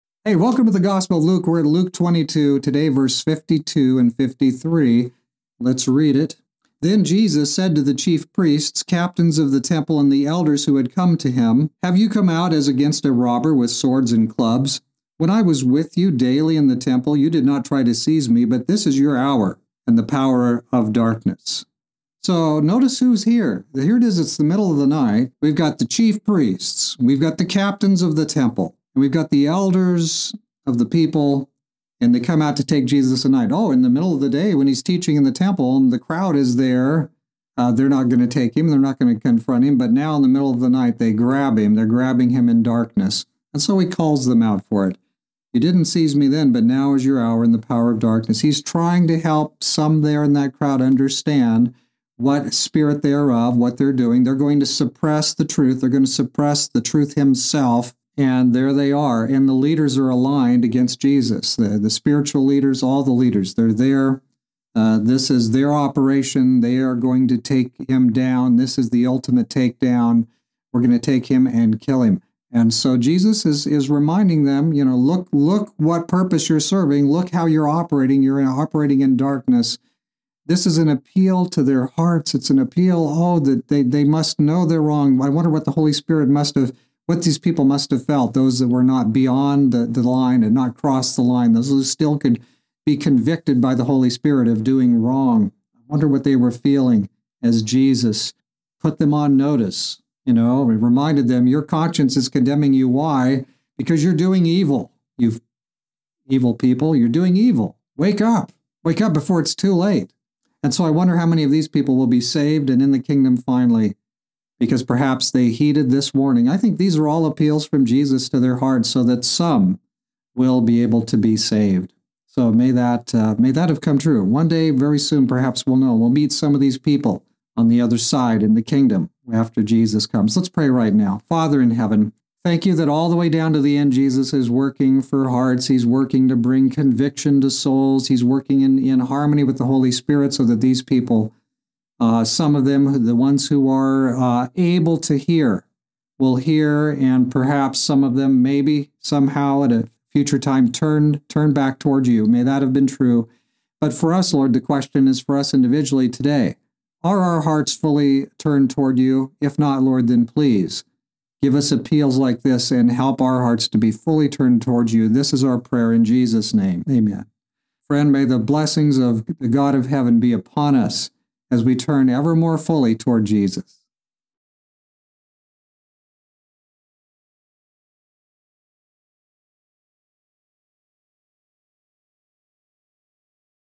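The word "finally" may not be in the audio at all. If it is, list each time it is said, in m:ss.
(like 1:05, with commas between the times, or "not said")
1:53.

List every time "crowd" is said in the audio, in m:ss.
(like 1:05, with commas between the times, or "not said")
0:35, 0:50.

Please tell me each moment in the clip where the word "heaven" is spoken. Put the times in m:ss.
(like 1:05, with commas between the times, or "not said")
2:11, 2:49.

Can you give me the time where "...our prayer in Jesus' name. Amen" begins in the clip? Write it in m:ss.
2:45.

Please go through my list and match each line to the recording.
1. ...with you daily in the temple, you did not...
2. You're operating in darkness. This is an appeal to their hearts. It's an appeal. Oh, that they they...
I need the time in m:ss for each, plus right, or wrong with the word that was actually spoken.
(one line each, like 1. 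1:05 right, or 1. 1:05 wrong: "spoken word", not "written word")
1. 0:15 right
2. 1:18 right.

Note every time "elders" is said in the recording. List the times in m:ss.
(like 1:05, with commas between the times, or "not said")
0:10, 0:29.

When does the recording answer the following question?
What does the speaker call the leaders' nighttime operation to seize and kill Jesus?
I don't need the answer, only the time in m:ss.
1:08.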